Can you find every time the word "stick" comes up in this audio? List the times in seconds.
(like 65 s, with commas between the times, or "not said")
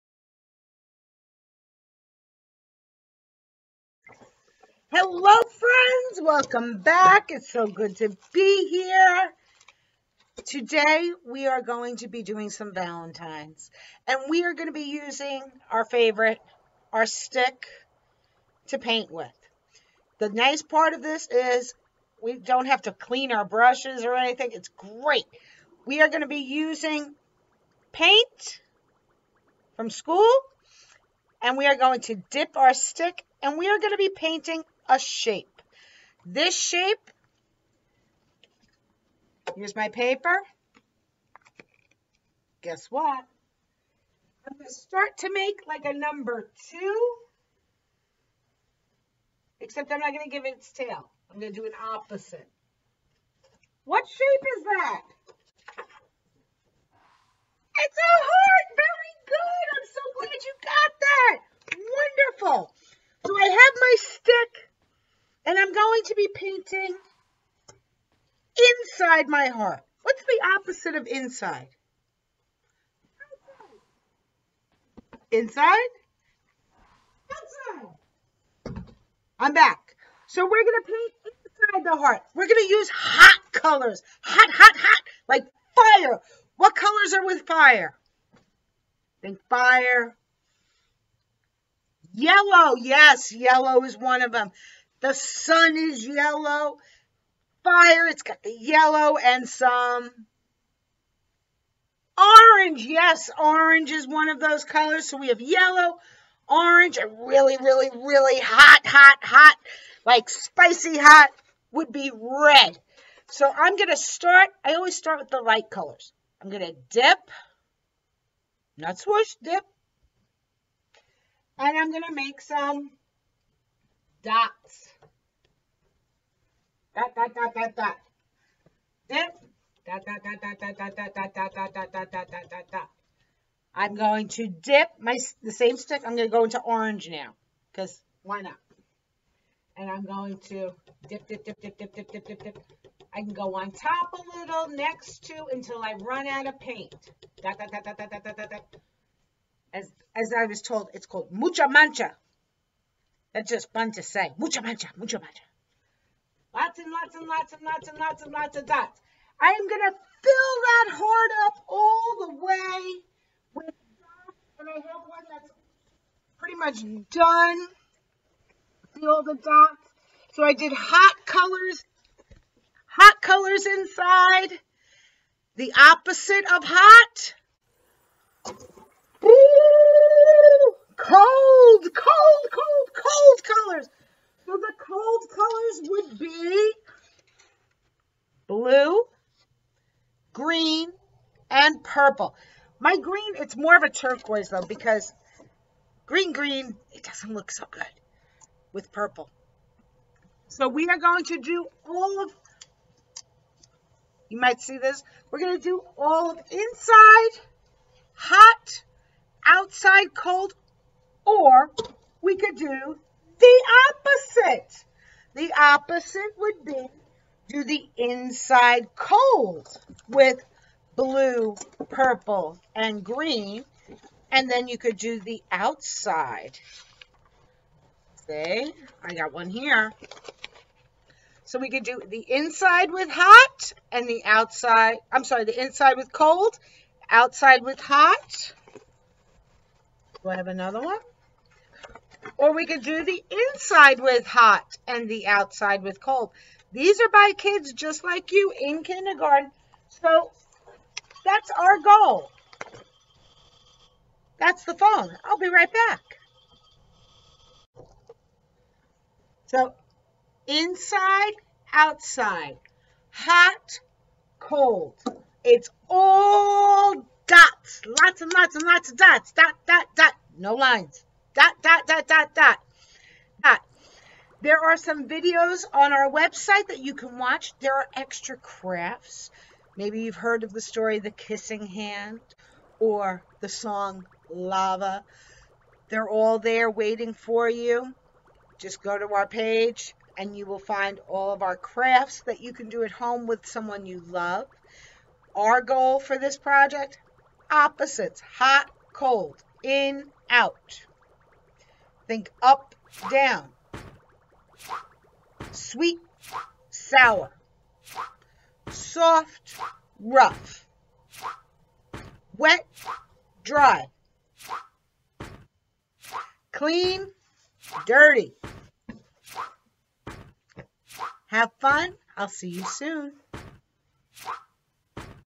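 17 s, 32 s, 63 s, 135 s.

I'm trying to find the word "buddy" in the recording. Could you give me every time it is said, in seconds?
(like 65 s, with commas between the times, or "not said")
not said.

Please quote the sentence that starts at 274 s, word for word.
There are some videos on our website that you can watch.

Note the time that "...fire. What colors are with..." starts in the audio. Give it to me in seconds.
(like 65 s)
85 s.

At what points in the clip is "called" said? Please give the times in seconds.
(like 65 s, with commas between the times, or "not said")
151 s.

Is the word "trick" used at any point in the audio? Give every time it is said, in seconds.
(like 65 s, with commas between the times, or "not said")
not said.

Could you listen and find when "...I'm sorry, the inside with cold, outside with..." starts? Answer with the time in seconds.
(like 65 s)
235 s.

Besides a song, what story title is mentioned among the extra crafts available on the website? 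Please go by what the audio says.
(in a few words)
The Kissing Hand.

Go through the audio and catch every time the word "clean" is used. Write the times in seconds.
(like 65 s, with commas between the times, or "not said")
22 s, 316 s.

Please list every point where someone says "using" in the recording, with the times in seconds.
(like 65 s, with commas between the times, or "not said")
14 s, 26 s.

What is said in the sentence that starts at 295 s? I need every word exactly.
Our goal for this project opposites hot, cold, in, out.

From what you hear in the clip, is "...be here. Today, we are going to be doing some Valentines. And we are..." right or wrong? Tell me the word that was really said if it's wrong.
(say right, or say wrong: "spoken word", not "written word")
right.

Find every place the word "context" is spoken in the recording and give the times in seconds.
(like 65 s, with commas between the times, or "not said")
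not said.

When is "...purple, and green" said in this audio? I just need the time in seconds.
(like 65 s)
221 s.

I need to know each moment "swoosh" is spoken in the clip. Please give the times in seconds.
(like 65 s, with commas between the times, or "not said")
118 s.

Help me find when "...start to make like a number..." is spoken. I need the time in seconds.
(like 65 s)
44 s.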